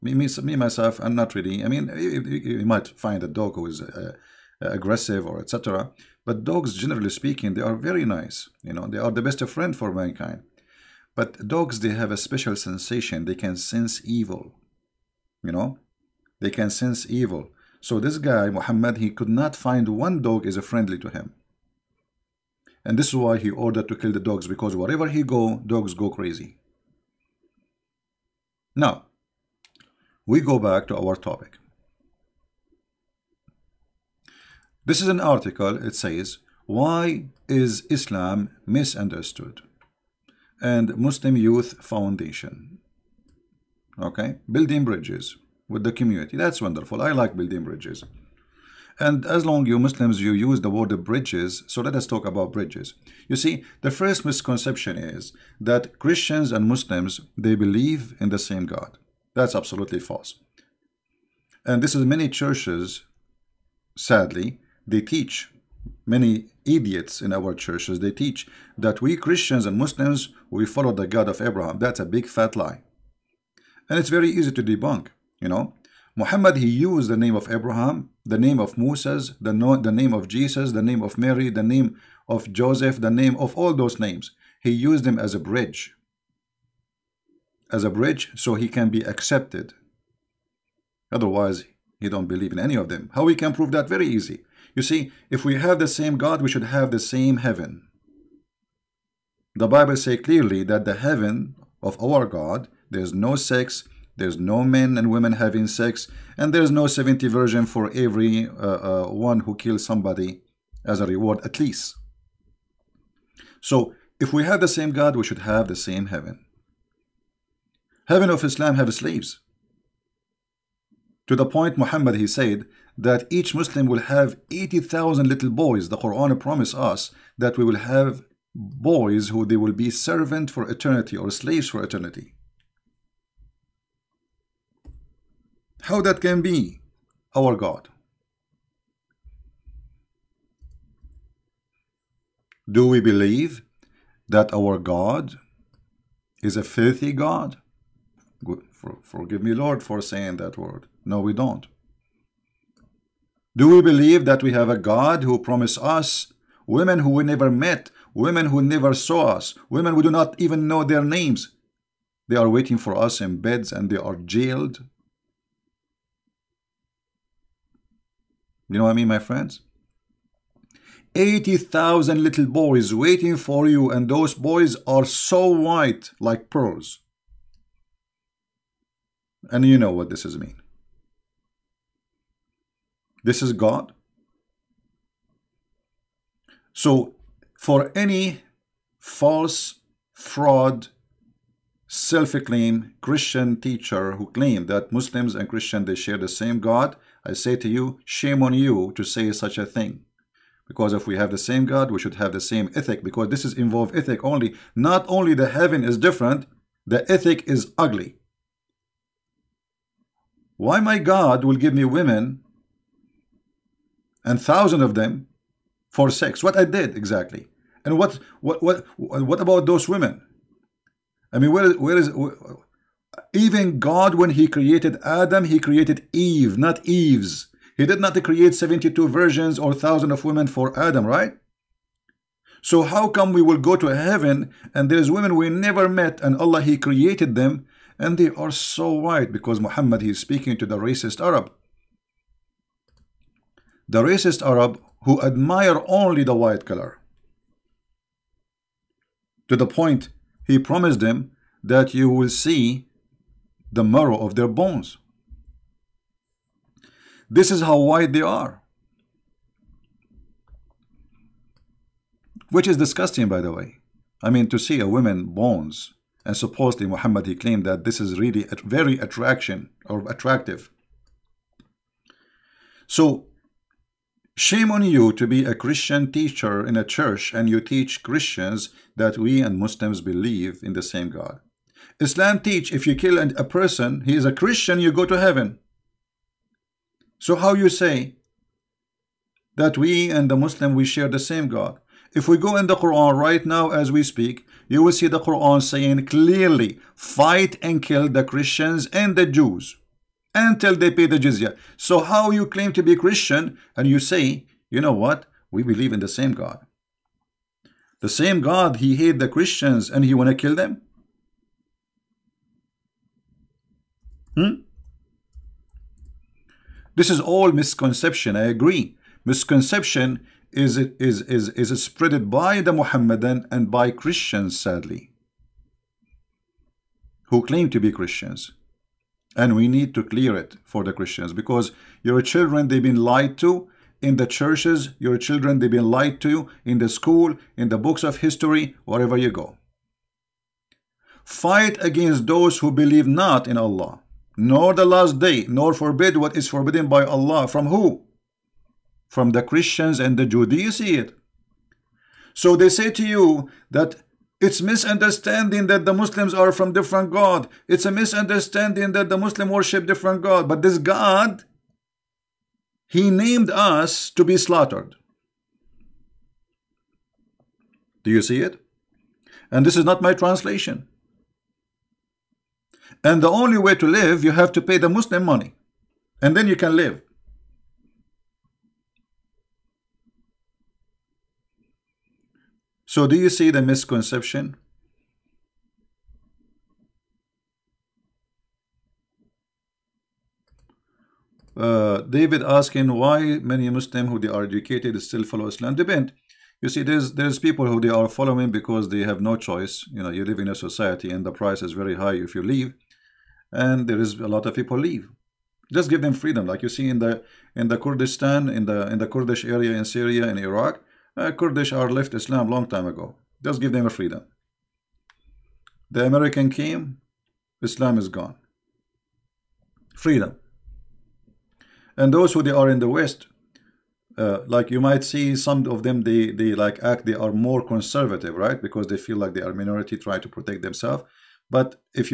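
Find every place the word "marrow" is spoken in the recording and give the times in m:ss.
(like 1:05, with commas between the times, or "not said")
4:13.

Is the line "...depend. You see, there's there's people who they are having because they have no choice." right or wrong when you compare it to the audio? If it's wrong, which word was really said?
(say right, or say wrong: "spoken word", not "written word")
wrong: "following", not "having".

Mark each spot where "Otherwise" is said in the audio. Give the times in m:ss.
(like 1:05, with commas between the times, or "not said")
1:31.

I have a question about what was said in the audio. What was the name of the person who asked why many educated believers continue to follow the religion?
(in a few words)
David.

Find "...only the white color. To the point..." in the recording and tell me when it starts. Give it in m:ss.
4:05.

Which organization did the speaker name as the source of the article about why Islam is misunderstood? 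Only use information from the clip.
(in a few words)
Muslim Youth Foundation.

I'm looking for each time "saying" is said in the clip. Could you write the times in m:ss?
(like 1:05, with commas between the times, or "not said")
2:30, 4:55.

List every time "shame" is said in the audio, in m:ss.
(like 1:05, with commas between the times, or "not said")
3:18, 4:34.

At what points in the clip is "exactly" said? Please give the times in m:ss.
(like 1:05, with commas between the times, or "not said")
3:36.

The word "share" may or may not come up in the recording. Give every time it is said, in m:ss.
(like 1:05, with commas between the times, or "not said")
3:15, 4:50.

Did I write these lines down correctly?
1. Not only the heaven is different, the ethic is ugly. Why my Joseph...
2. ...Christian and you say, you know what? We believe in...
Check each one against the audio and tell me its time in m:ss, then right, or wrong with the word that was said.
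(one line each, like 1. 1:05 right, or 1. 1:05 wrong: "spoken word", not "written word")
1. 3:24 wrong: "God", not "Joseph"
2. 5:02 right.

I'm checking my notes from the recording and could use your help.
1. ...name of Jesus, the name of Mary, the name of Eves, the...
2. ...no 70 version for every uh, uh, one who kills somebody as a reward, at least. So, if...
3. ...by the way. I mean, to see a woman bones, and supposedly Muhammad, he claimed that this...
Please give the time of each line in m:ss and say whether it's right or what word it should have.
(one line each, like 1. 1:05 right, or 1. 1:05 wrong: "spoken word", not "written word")
1. 1:19 wrong: "Joseph", not "Eves"
2. 1:46 right
3. 4:23 right.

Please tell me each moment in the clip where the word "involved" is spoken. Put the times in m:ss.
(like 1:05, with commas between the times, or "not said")
3:23.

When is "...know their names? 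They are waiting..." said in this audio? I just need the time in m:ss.
2:40.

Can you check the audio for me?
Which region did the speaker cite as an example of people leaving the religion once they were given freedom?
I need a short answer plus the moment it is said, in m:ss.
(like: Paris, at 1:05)
Kurdistan, at 6:47.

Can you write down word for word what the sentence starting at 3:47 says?
He did not create 72 virgins or thousands of women for Adam, right?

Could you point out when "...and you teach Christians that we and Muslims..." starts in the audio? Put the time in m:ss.
4:37.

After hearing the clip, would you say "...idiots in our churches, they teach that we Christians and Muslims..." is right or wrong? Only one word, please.
right.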